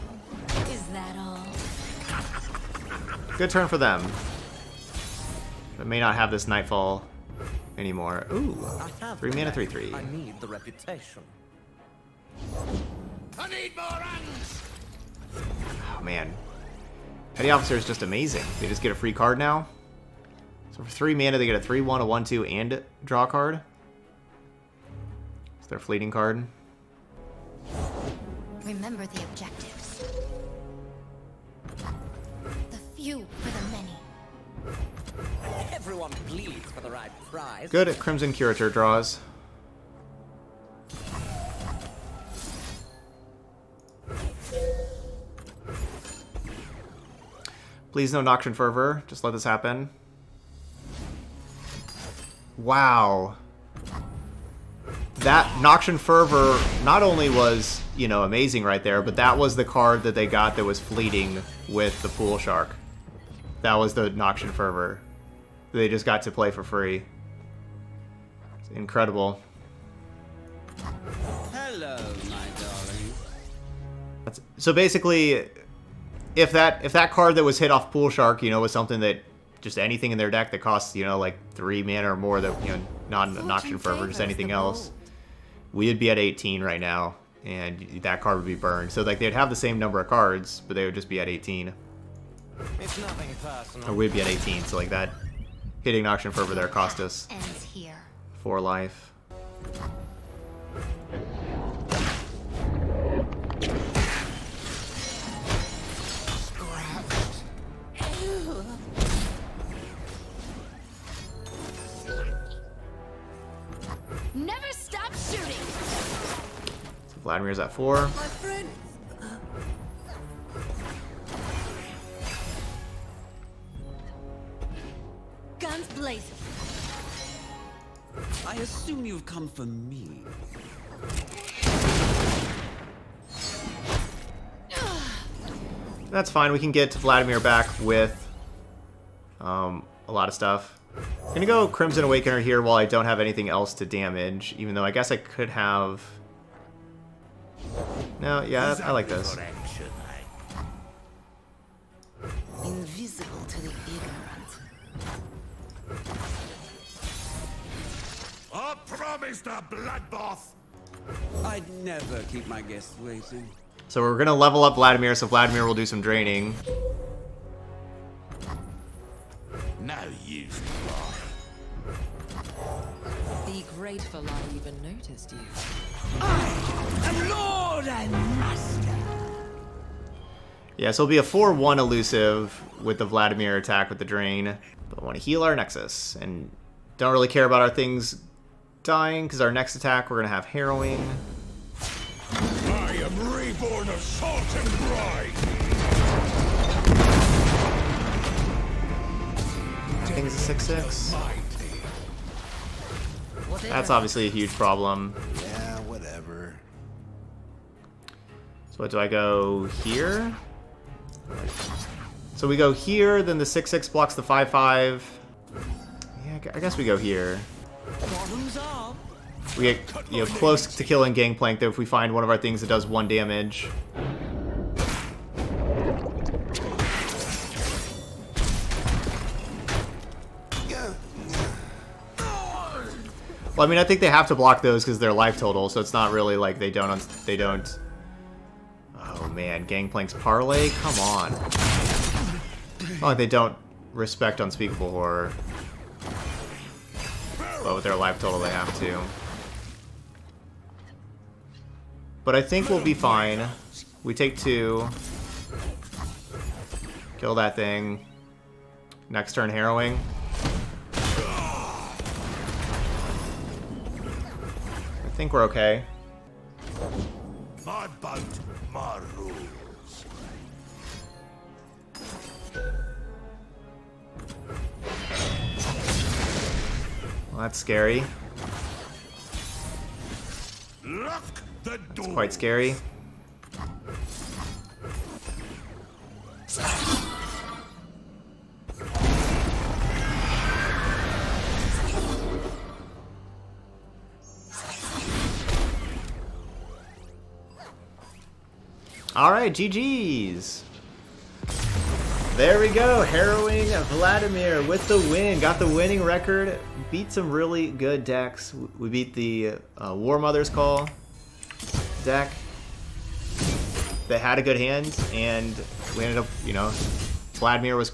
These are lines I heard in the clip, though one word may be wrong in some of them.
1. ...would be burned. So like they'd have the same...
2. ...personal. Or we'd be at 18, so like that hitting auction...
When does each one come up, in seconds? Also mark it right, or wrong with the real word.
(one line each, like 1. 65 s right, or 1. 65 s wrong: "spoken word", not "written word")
1. 88 s right
2. 93 s right.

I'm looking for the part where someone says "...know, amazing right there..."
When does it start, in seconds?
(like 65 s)
58 s.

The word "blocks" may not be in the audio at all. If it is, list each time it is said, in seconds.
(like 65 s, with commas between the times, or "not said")
213 s, 234 s.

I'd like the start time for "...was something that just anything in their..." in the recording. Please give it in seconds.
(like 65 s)
78 s.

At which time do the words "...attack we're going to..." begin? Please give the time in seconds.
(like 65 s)
189 s.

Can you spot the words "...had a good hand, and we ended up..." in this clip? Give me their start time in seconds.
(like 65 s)
314 s.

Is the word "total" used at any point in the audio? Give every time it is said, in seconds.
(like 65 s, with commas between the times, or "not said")
235 s, 248 s.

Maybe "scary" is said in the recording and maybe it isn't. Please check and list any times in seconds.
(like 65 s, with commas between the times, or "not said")
277 s, 282 s.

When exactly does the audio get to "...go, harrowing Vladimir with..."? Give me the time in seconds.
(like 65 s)
302 s.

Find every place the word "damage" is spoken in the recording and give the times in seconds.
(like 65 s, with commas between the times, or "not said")
143 s, 223 s.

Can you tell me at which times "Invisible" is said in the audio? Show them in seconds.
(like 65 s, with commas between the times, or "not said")
152 s.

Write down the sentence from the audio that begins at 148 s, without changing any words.
No, yeah, I, I like this.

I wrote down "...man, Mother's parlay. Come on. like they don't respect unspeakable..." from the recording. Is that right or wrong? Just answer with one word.
wrong.